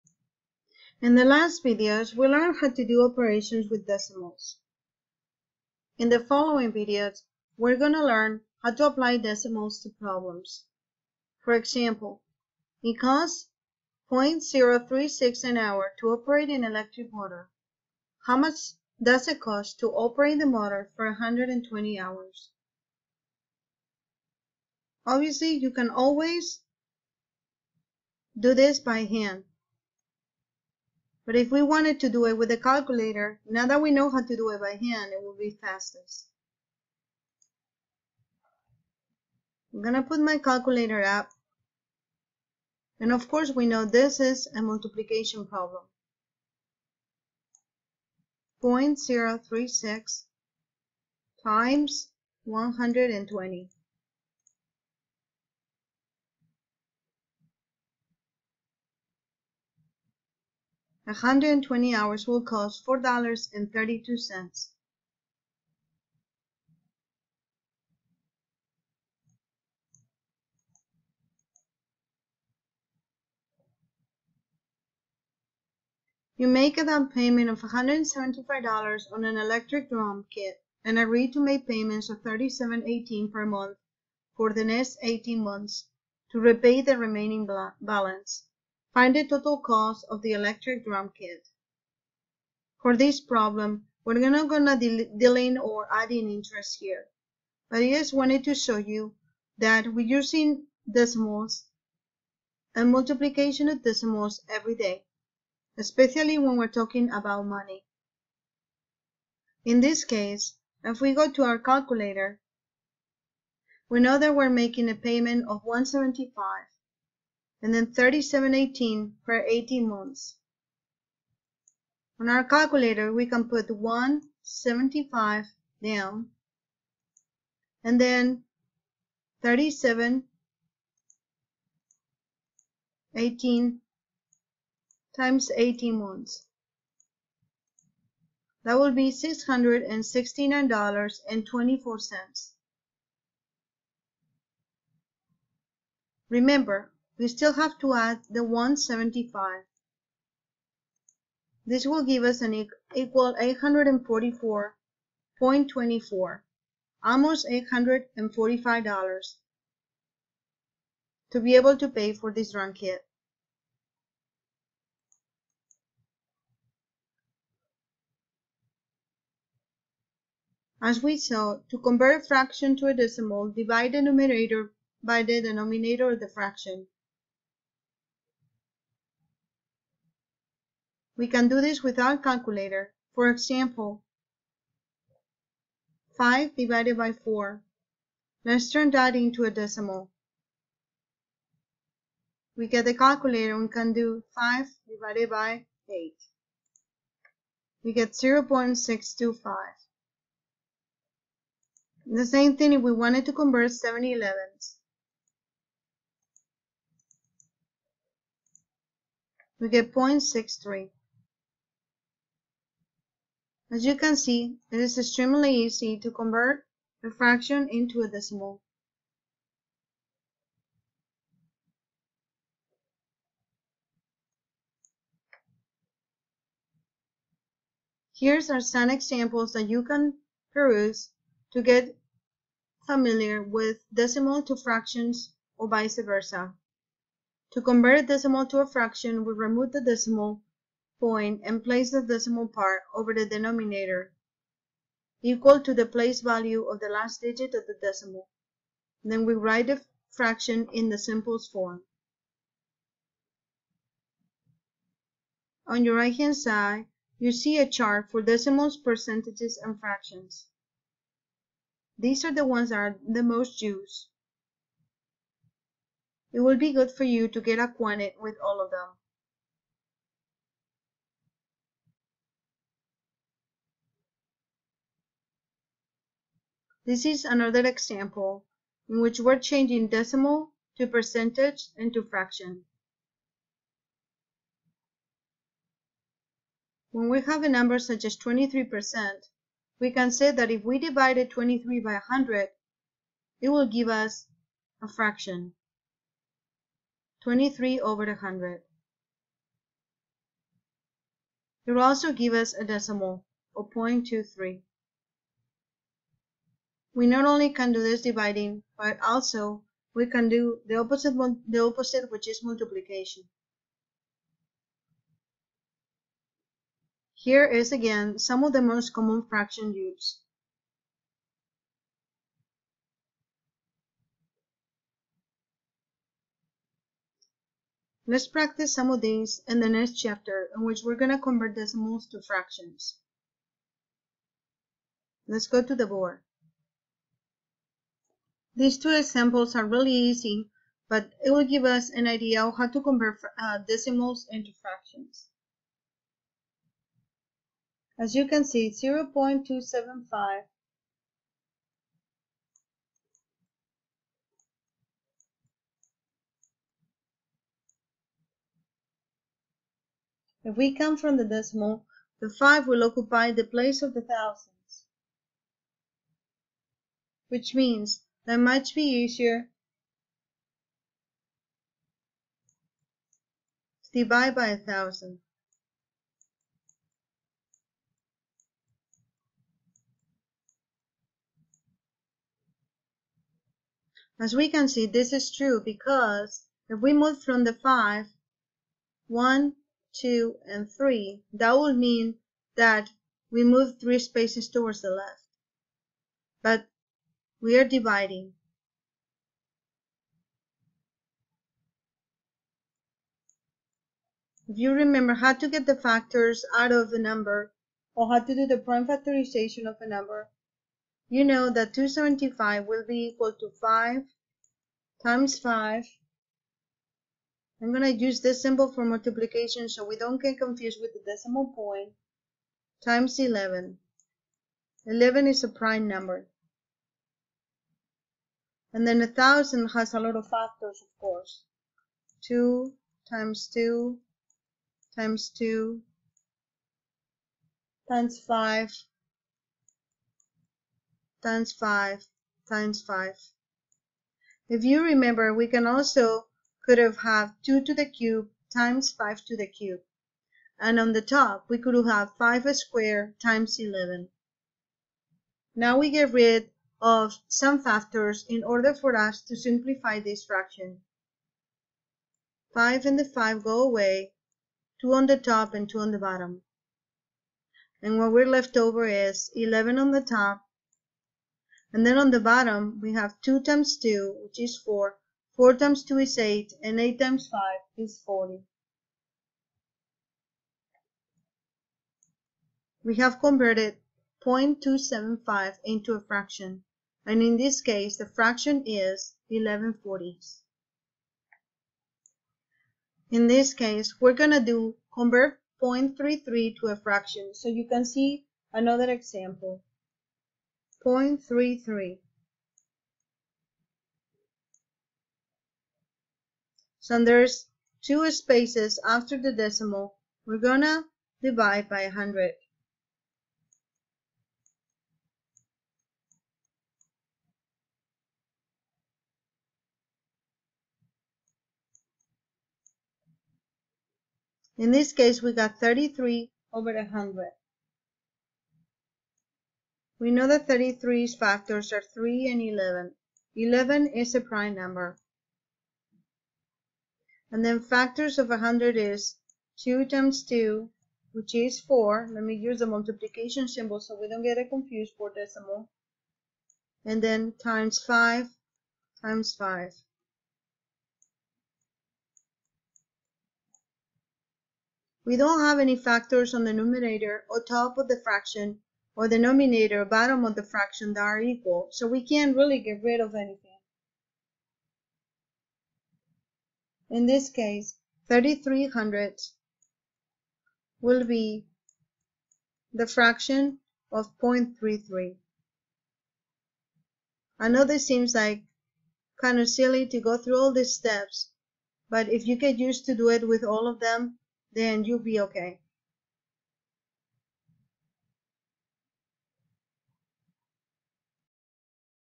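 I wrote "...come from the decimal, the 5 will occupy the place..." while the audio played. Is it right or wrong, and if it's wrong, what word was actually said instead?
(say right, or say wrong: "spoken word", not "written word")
right.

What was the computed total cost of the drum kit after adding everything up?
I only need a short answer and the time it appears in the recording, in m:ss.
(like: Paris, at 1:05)
844.24, at 2:33.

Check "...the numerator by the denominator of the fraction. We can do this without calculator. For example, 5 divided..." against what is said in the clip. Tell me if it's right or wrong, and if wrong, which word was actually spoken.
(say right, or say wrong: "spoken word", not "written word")
right.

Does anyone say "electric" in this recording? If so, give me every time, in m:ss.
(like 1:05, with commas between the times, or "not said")
0:16, 1:19, 1:30.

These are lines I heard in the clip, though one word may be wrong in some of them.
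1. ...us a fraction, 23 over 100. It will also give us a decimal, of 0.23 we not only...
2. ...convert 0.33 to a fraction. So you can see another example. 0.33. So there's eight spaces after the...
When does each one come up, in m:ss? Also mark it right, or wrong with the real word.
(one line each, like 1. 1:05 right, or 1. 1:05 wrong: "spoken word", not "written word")
1. 4:53 right
2. 8:14 wrong: "two", not "eight".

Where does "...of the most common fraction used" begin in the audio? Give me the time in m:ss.
5:18.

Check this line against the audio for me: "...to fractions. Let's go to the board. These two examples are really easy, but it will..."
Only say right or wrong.
right.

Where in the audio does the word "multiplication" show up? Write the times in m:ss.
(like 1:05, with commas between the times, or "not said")
0:44, 1:42, 5:12, 6:58, 9:02.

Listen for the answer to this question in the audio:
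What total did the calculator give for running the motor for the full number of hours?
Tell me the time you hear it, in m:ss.
1:02.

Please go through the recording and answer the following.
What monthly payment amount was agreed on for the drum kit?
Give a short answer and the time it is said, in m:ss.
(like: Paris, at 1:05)
$37.18, at 1:22.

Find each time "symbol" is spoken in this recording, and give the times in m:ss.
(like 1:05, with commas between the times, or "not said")
6:58, 9:03.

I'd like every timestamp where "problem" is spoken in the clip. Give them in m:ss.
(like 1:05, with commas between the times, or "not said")
0:09, 0:45, 1:33.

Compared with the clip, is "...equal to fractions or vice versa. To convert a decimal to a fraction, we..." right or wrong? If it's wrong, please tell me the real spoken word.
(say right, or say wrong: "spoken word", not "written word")
wrong: "decimal", not "equal".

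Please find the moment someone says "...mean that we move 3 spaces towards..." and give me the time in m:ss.
6:31.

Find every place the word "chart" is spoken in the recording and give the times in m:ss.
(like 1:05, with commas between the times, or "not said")
4:17.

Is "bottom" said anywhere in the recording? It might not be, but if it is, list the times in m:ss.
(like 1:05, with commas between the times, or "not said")
7:45, 7:52, 9:19.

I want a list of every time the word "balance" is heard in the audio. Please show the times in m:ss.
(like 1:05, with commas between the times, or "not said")
1:27.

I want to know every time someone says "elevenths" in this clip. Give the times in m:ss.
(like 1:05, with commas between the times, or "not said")
3:24.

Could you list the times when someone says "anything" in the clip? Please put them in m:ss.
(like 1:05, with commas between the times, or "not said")
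9:23.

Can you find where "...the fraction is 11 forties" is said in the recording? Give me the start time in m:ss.
8:07.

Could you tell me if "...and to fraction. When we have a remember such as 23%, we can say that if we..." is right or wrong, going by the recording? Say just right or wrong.
wrong.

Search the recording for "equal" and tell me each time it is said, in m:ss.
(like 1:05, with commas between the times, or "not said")
2:32, 4:05, 6:53, 9:21.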